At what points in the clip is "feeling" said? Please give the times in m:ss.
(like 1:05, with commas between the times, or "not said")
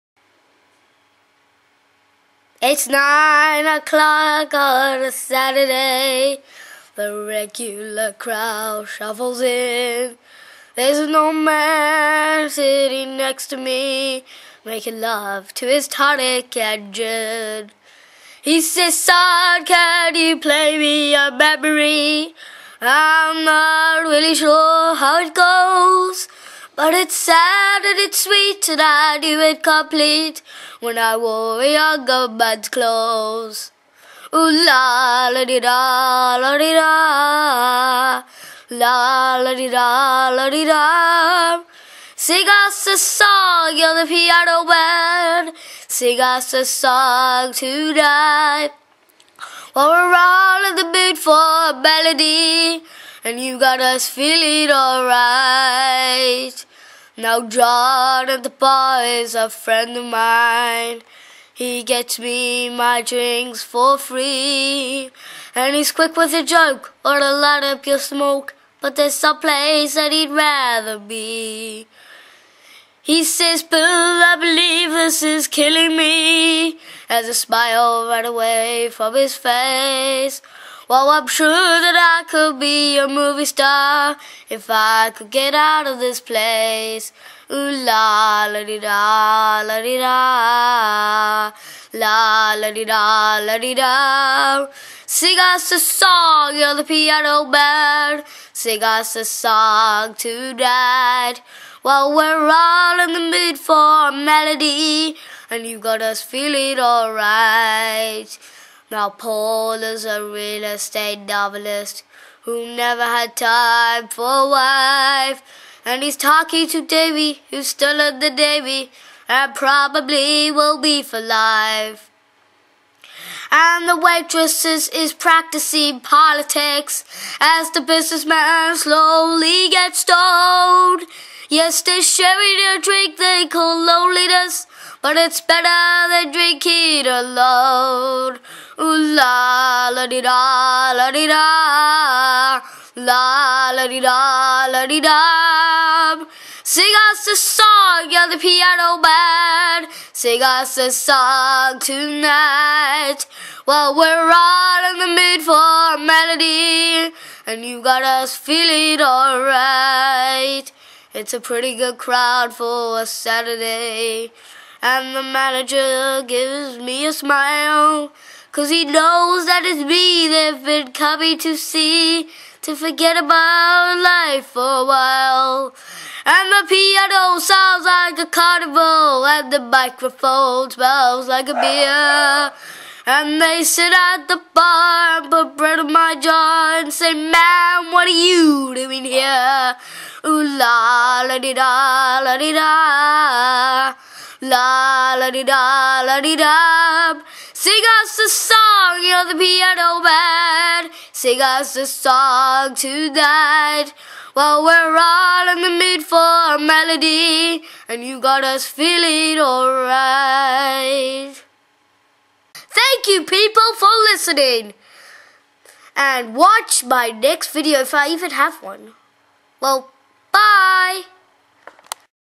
0:54, 1:46, 2:38, 3:28.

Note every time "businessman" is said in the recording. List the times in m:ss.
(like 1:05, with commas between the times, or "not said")
2:07.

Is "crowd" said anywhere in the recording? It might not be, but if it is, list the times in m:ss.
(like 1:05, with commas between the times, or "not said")
0:08, 2:41.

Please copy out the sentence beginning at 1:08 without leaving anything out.
But there's a place that he'd rather be.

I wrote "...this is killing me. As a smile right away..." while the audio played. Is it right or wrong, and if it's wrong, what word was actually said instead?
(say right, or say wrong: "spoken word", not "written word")
right.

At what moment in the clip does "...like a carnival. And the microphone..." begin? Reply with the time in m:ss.
2:57.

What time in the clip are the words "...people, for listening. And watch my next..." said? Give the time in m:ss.
3:33.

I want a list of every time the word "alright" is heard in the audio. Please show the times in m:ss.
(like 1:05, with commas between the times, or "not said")
0:54, 1:46, 2:39, 3:29.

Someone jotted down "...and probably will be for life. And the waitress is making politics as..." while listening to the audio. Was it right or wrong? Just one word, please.
wrong.